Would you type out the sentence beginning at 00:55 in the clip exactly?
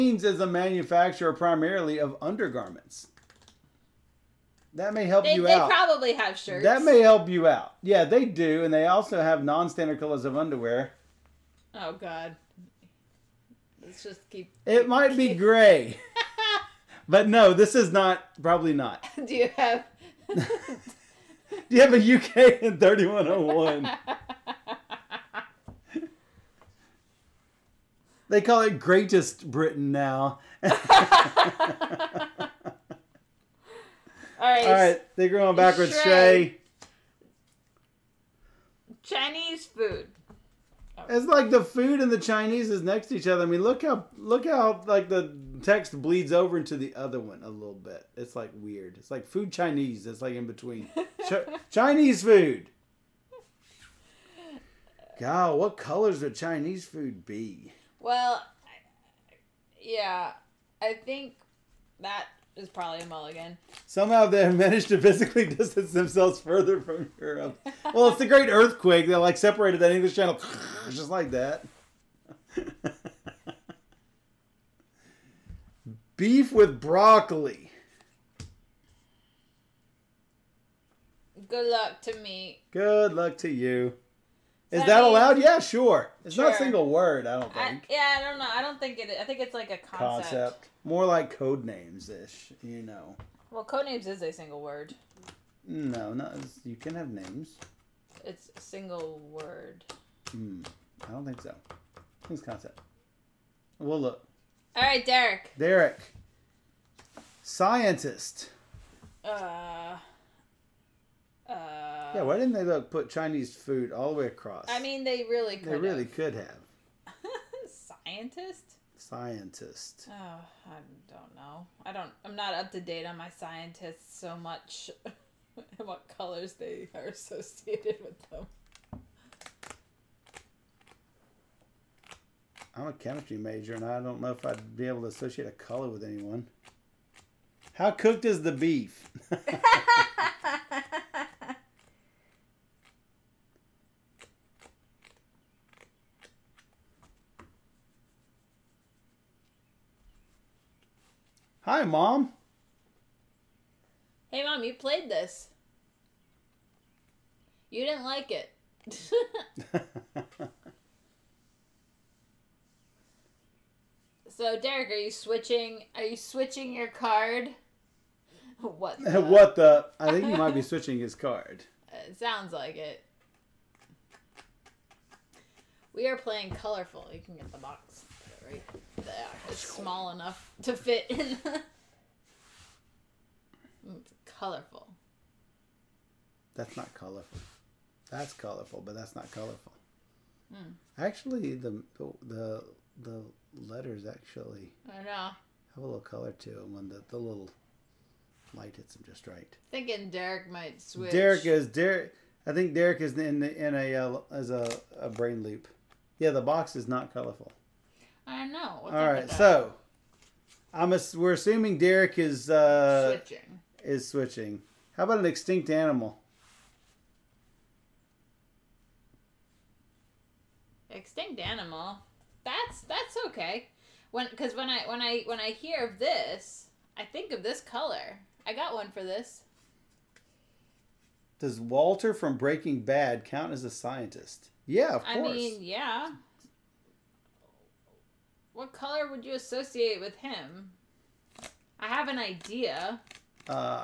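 God, what colors would Chinese food be?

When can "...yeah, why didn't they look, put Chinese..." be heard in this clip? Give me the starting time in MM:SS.
01:52.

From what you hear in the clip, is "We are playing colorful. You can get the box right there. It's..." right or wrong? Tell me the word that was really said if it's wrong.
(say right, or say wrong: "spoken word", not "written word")
right.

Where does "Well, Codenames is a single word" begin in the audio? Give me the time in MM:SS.
01:33.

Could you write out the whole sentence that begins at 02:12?
I'm a chemistry major, and I don't know if I'd be able to associate a color with anyone.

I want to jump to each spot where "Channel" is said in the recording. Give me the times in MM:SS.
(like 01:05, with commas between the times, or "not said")
01:10.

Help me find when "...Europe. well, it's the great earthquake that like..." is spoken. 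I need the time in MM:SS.
01:07.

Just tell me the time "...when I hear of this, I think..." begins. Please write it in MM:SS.
03:45.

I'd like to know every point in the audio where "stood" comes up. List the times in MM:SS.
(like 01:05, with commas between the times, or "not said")
not said.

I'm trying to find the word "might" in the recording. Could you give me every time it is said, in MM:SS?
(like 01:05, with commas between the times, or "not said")
00:14, 02:50, 03:20.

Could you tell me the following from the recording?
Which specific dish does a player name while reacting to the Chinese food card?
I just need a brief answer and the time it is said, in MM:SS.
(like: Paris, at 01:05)
Beef with broccoli, at 01:16.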